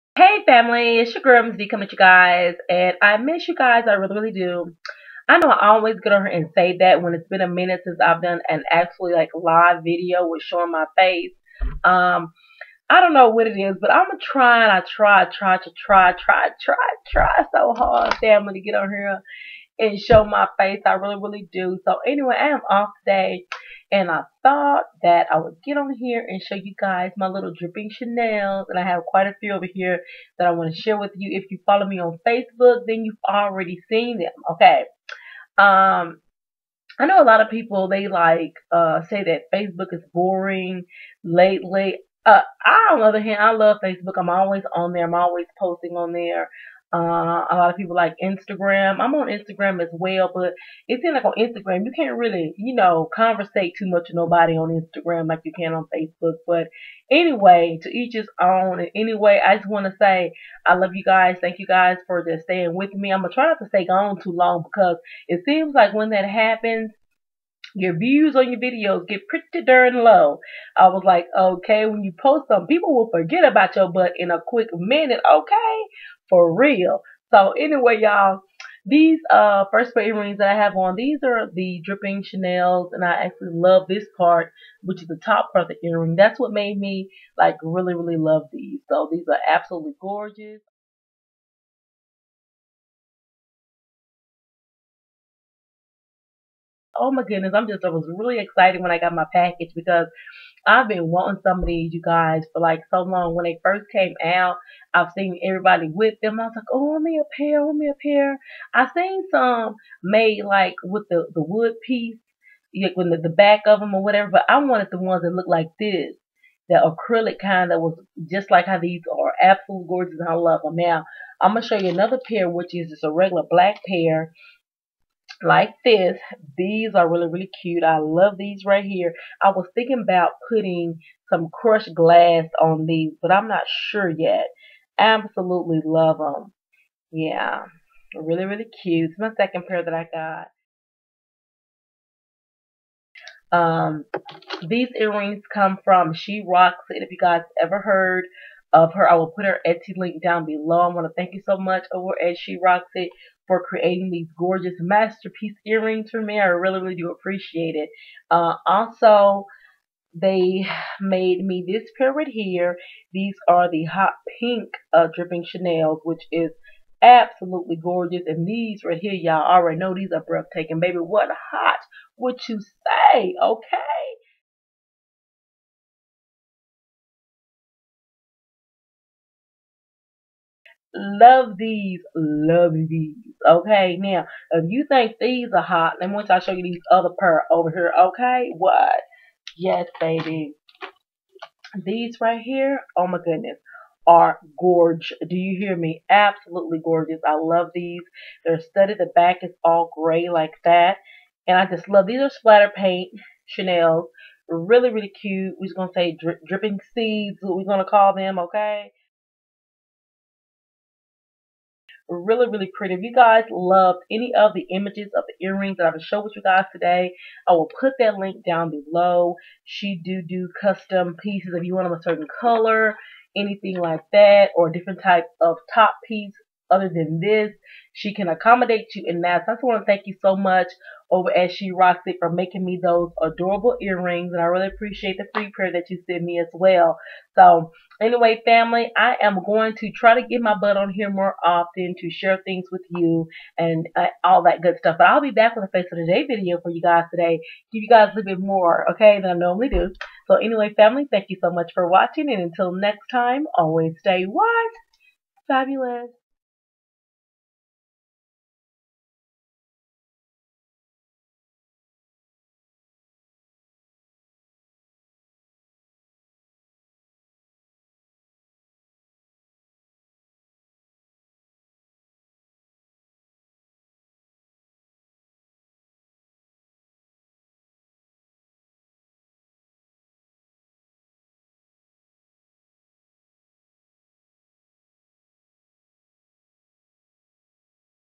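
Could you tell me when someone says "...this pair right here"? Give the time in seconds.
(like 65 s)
161 s.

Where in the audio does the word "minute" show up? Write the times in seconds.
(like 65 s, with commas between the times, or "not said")
7 s, 74 s.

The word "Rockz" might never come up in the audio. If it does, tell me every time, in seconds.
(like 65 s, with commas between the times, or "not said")
146 s, 152 s, 231 s.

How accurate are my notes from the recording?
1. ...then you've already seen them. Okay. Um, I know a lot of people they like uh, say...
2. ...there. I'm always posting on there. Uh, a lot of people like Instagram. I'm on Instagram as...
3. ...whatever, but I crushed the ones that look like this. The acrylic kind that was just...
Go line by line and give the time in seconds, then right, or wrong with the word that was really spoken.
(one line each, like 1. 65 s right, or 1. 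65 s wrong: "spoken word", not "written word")
1. 32 s right
2. 44 s right
3. 114 s wrong: "wanted", not "crushed".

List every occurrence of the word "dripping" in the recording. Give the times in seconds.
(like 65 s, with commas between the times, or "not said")
27 s, 81 s, 165 s, 206 s.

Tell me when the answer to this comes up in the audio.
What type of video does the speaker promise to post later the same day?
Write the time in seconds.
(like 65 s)
245 s.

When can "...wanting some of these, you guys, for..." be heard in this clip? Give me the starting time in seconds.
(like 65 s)
101 s.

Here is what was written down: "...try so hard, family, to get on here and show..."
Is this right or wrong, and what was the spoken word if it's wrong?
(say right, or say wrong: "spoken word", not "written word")
right.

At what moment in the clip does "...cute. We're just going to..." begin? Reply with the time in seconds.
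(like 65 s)
205 s.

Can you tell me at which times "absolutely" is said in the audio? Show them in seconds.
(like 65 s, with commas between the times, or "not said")
89 s, 119 s, 134 s, 167 s, 196 s.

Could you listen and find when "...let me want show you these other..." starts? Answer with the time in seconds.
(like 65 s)
185 s.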